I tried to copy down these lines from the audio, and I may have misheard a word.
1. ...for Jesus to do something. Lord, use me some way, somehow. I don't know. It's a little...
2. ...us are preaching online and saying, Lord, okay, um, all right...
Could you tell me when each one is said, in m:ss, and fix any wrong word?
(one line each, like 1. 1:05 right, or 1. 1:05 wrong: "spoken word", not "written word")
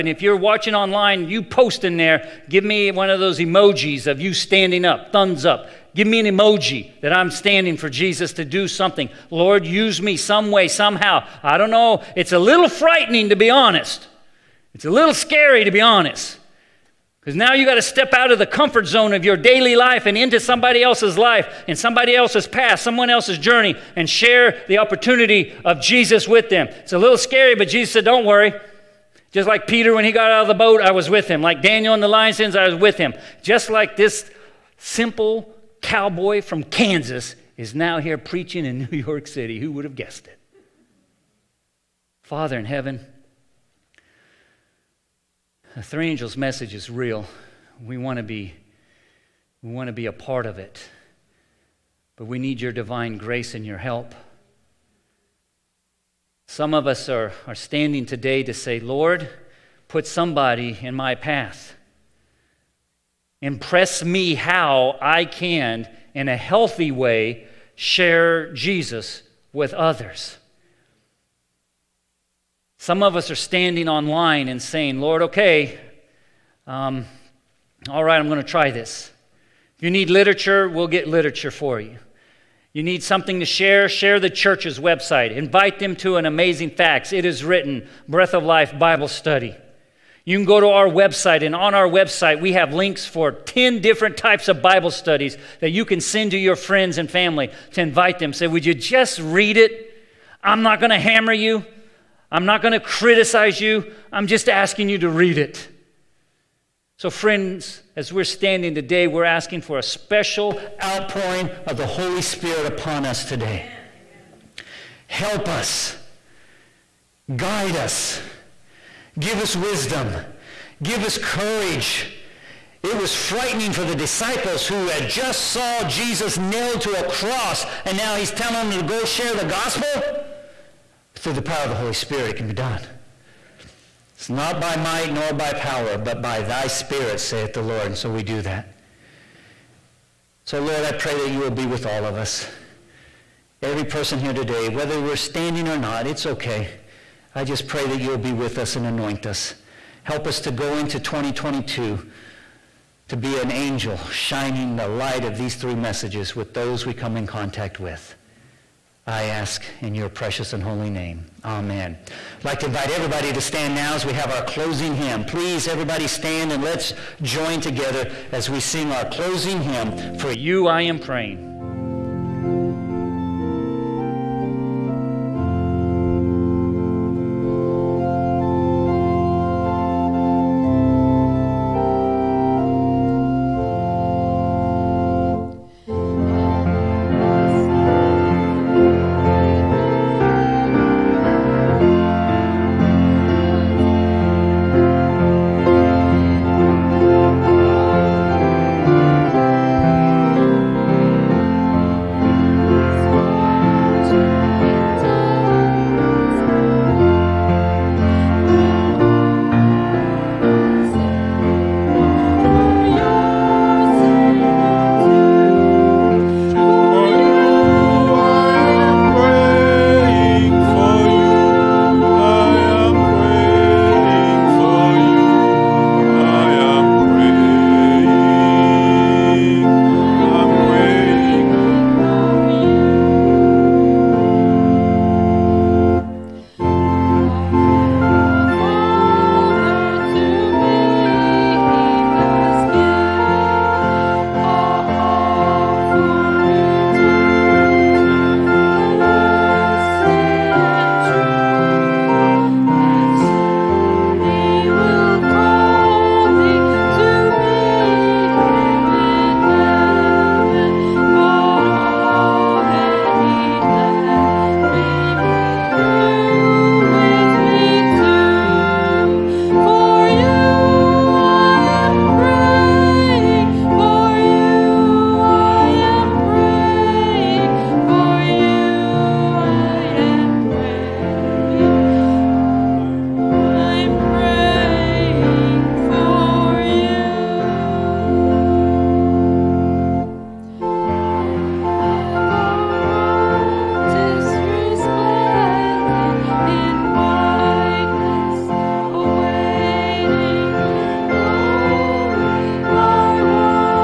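1. 0:07 right
2. 1:13 wrong: "standing", not "preaching".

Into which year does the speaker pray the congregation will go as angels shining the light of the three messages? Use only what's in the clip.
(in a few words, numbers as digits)
2022.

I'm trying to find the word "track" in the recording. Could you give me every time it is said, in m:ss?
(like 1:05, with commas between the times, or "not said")
not said.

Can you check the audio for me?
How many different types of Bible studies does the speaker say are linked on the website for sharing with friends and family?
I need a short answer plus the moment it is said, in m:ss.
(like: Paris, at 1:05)
10, at 1:33.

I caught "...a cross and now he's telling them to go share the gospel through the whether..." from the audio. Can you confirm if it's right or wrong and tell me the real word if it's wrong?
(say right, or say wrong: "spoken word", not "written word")
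wrong: "power", not "whether".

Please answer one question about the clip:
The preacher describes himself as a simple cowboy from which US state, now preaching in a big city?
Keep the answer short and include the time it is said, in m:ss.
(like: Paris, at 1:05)
Kansas, at 0:36.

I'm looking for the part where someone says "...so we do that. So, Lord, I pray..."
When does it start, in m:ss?
2:17.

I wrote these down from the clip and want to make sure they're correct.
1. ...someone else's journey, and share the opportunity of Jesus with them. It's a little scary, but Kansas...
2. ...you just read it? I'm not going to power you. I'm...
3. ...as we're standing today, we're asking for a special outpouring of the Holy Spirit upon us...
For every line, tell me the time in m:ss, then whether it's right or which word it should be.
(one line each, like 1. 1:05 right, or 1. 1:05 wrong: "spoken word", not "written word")
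1. 0:22 wrong: "Jesus", not "Kansas"
2. 1:38 wrong: "hammer", not "power"
3. 1:47 right.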